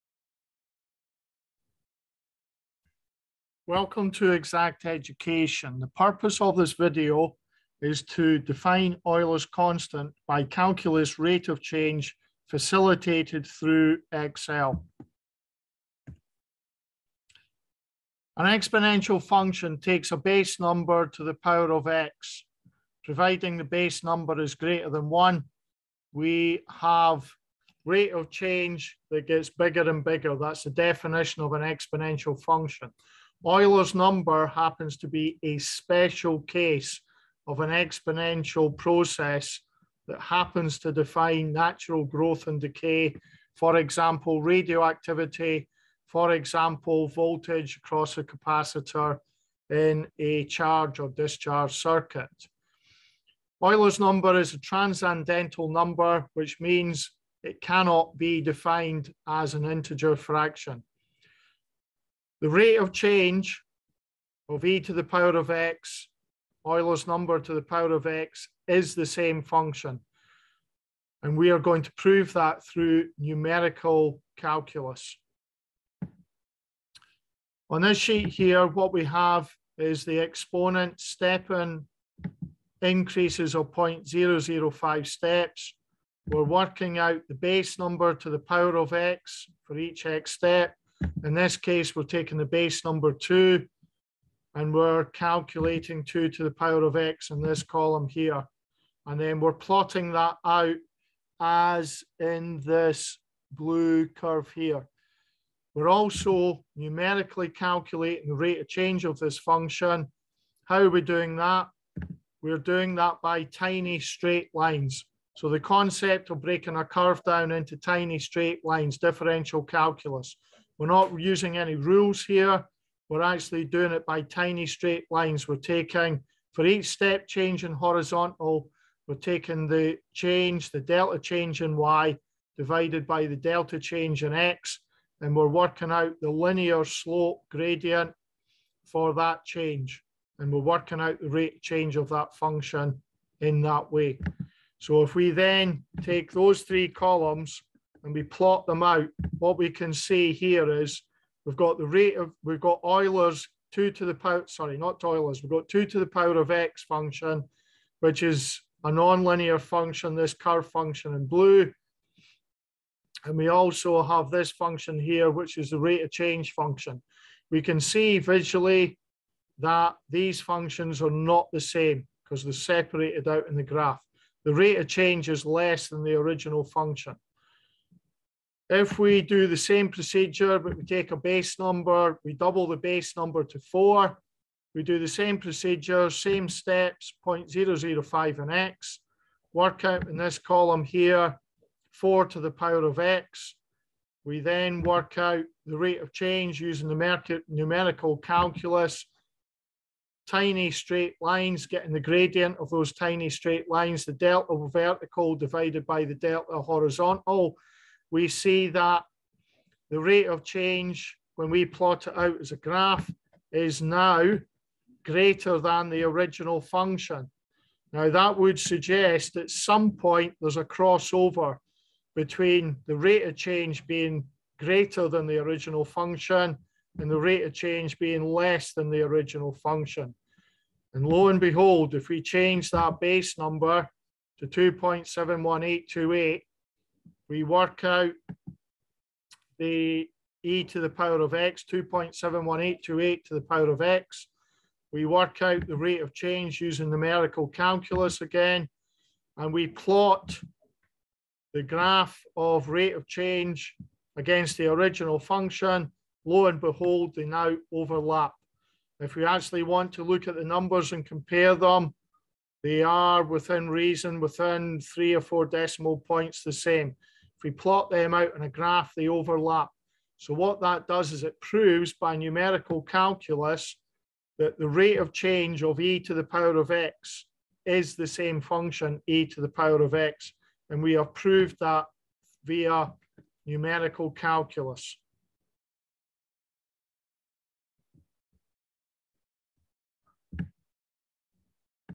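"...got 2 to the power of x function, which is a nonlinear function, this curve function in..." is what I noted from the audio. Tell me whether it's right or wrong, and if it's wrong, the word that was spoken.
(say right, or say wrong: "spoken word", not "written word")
right.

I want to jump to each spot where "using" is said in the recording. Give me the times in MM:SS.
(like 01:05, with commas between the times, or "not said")
02:01, 03:16, 04:06.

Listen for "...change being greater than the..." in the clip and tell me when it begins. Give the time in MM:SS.
03:43.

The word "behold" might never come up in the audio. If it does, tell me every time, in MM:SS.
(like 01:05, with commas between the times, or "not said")
03:51, 04:16.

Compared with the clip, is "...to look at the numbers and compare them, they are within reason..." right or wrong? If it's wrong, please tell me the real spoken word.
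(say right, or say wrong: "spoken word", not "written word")
right.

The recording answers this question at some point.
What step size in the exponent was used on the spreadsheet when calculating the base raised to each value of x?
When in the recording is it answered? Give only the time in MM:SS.
01:23.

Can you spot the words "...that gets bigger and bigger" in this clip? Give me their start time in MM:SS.
00:29.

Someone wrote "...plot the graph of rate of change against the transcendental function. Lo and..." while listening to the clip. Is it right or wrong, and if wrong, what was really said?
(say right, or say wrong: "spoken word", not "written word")
wrong: "original", not "transcendental".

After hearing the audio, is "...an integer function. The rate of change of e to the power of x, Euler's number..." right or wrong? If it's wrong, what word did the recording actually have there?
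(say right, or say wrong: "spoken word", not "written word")
wrong: "fraction", not "function".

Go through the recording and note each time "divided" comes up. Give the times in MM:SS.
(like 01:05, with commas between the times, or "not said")
02:12, 03:25.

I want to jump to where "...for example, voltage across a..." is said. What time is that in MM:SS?
00:46.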